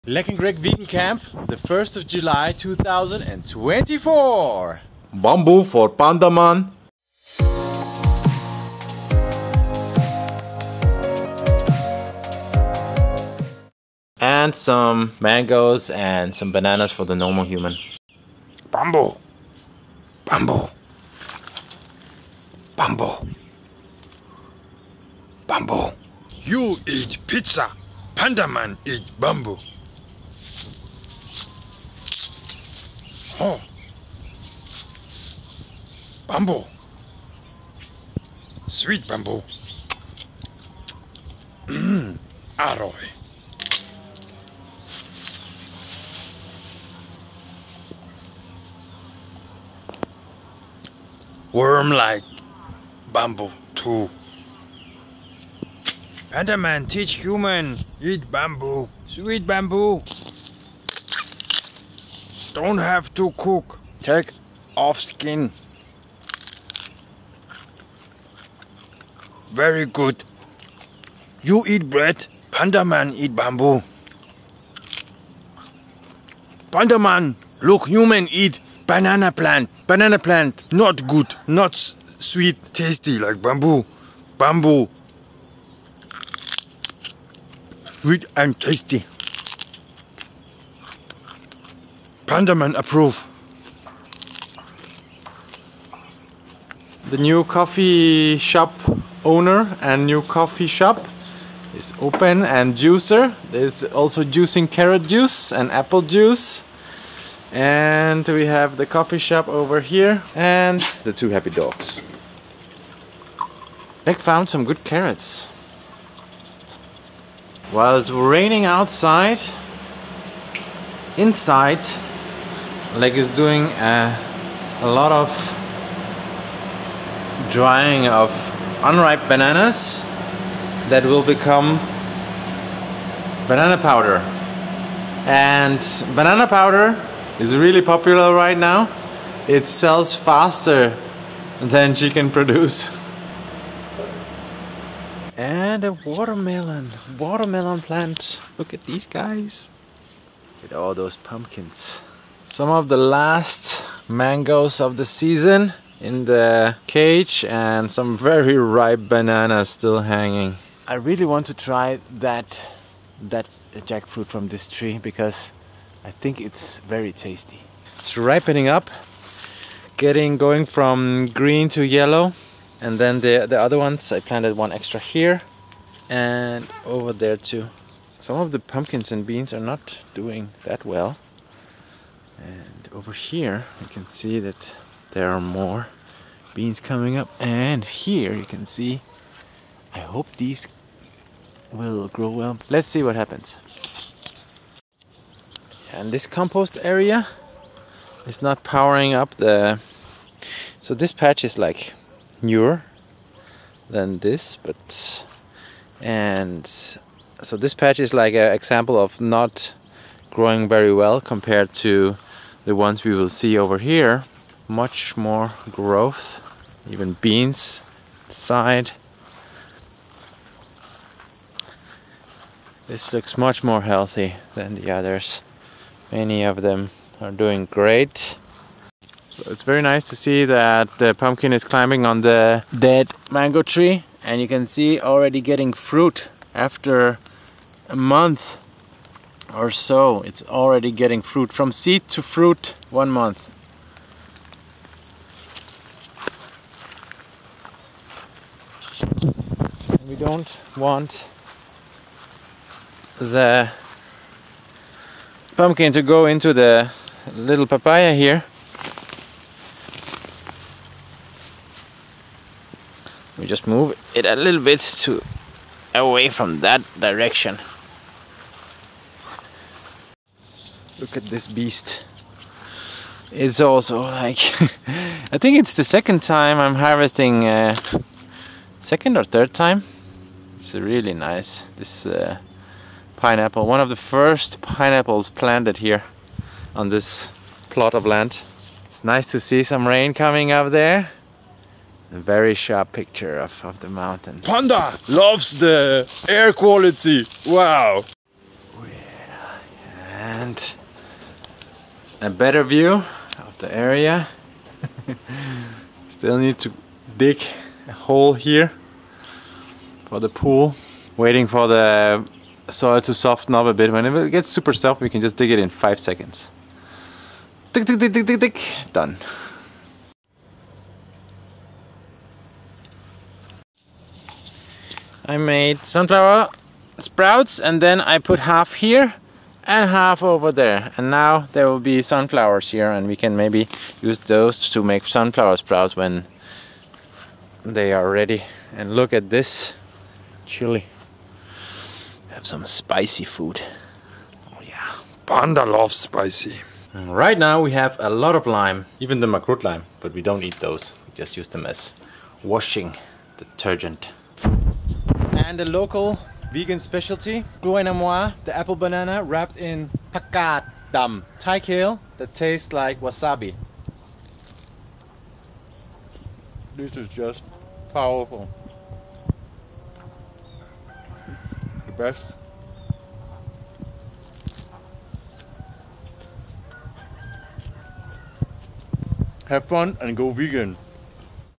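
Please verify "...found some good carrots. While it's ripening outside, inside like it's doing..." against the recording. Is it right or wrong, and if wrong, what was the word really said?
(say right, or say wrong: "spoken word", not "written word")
wrong: "raining", not "ripening".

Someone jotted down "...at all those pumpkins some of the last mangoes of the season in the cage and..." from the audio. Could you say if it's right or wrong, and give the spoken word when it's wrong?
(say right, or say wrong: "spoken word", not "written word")
right.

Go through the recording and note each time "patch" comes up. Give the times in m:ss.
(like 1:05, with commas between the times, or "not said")
3:21, 3:27.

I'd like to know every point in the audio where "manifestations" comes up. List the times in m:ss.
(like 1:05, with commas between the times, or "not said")
not said.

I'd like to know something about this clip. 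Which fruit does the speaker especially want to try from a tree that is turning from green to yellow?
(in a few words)
jackfruit.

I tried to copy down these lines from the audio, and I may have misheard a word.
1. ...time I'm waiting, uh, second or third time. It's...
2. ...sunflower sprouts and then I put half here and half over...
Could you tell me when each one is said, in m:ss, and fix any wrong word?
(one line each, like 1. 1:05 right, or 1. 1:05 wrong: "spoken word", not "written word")
1. 4:36 wrong: "harvesting", not "waiting"
2. 5:25 right.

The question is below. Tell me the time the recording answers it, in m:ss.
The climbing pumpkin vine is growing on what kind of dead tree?
3:52.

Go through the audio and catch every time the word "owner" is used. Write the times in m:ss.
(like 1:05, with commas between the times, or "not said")
1:39.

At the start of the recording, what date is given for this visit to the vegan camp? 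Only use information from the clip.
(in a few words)
1 July 2024.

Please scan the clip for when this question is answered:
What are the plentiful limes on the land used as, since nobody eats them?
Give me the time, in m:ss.
5:52.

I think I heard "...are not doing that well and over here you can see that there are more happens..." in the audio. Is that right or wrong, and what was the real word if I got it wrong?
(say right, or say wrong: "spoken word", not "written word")
wrong: "beans", not "happens".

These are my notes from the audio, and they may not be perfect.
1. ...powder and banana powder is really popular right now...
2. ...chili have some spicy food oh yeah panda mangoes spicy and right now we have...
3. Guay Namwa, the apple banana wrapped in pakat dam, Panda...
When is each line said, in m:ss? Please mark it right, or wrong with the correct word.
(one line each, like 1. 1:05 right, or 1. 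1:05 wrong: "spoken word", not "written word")
1. 2:13 right
2. 5:40 wrong: "loves", not "mangoes"
3. 5:57 wrong: "Thai", not "Panda".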